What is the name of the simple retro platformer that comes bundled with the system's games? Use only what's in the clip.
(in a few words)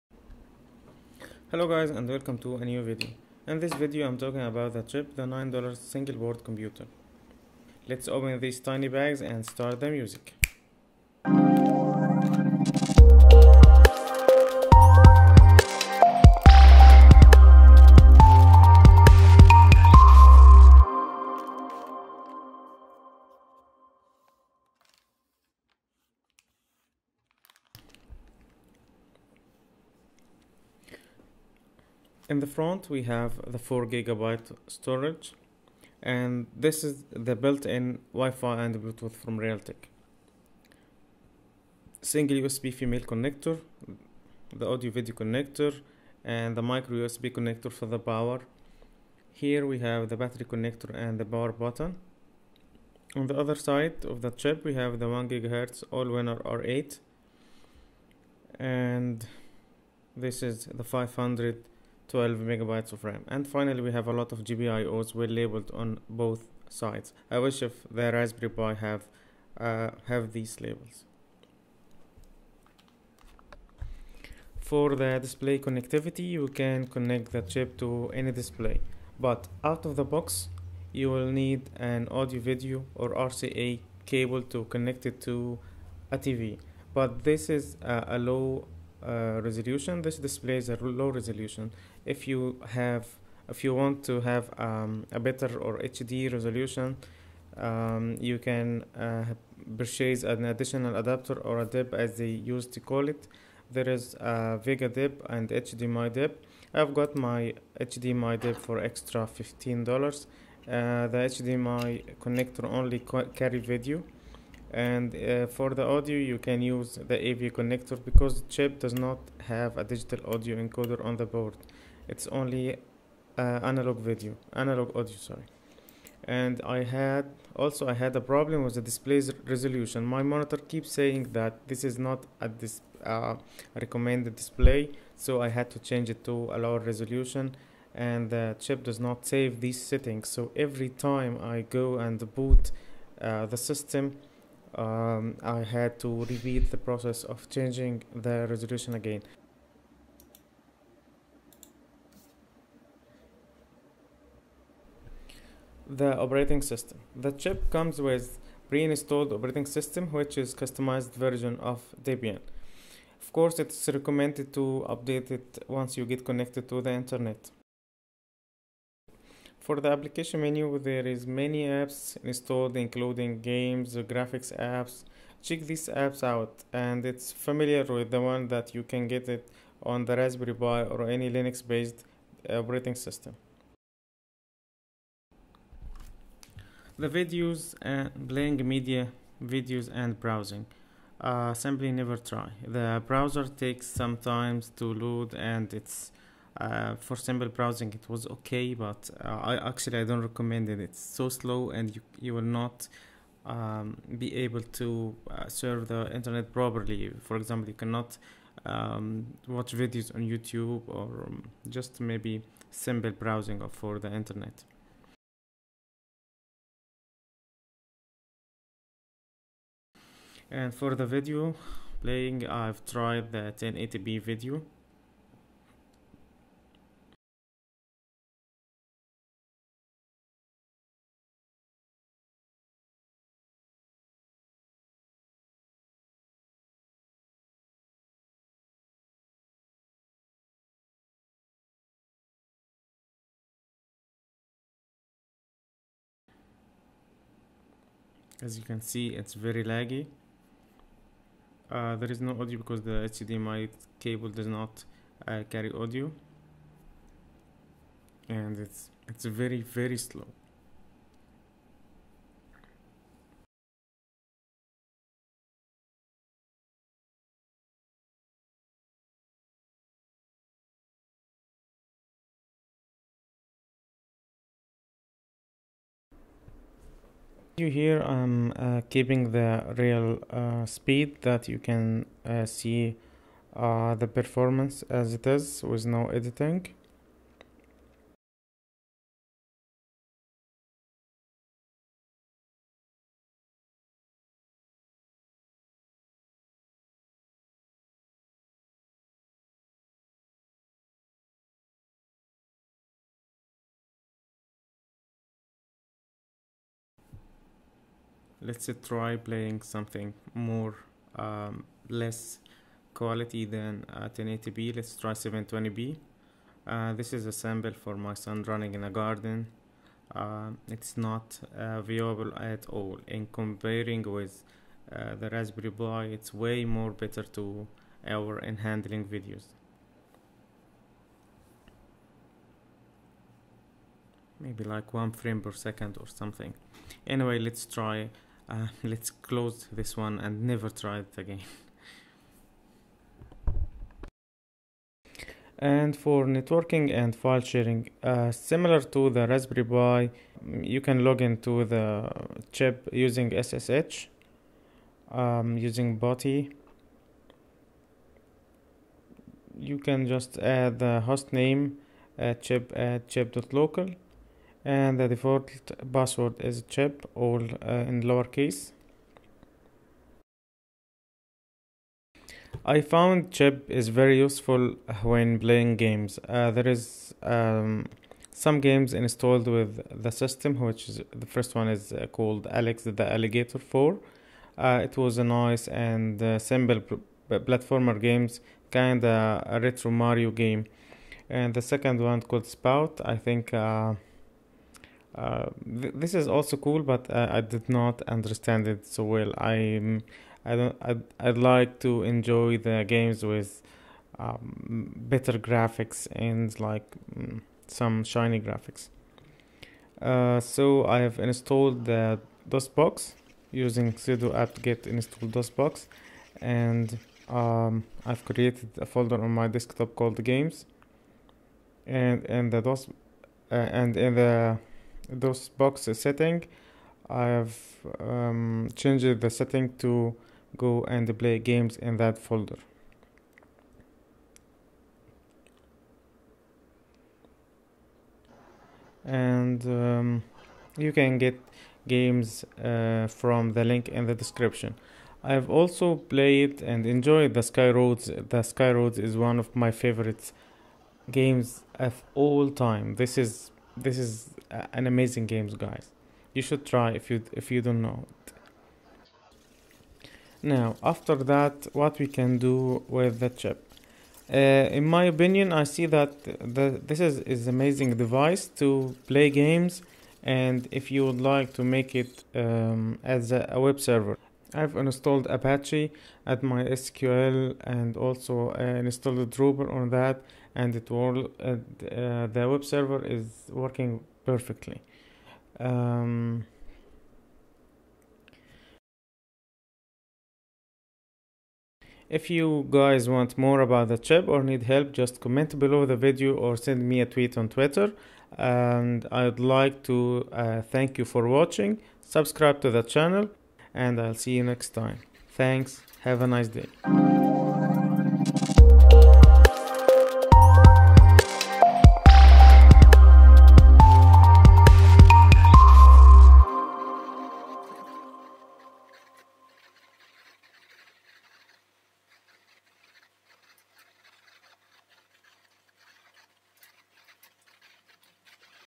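Alex the Allegator 4.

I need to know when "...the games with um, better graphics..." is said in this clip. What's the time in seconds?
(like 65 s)
402 s.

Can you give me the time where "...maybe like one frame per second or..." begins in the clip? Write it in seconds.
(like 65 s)
334 s.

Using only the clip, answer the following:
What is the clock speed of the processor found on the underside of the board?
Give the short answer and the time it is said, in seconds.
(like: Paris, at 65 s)
1 gigahertz, at 55 s.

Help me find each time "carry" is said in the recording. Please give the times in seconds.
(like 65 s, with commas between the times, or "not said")
113 s, 255 s.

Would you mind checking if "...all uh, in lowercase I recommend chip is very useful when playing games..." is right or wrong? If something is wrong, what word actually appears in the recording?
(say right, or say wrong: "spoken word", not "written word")
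wrong: "found", not "recommend".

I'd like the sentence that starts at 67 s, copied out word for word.
I wish if the Raspberry Pi have uh, have these labels.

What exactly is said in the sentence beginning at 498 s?
And I'd like to uh, thank you for watching.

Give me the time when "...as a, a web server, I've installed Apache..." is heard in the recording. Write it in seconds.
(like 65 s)
473 s.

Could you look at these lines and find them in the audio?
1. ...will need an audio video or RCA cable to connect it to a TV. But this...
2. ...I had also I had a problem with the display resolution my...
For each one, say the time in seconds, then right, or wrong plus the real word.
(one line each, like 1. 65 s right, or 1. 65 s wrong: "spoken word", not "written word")
1. 81 s right
2. 126 s right.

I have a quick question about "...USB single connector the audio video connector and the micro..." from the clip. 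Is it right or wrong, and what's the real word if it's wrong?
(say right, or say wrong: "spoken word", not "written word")
wrong: "female", not "single".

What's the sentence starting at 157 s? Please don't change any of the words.
The chip comes with pre-installed operating system which is customized version of Debian.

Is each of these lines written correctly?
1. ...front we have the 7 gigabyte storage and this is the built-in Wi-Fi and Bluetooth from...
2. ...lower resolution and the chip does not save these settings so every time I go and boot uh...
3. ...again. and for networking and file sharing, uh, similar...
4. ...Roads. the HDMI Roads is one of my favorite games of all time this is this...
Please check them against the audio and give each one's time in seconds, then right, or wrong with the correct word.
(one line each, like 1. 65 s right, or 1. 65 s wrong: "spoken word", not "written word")
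1. 32 s wrong: "4", not "7"
2. 136 s right
3. 341 s right
4. 447 s wrong: "Sky", not "HDMI".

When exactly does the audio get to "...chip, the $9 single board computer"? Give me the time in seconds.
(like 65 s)
4 s.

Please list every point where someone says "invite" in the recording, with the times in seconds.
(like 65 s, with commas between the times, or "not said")
not said.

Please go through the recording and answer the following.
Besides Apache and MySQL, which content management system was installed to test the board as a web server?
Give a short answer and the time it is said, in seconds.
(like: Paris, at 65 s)
Drupal, at 479 s.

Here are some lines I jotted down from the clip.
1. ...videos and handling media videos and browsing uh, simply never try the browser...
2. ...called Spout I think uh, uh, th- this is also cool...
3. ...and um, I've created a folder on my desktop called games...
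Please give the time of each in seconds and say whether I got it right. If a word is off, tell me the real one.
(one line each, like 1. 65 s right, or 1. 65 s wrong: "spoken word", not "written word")
1. 187 s wrong: "playing", not "handling"
2. 392 s right
3. 416 s right.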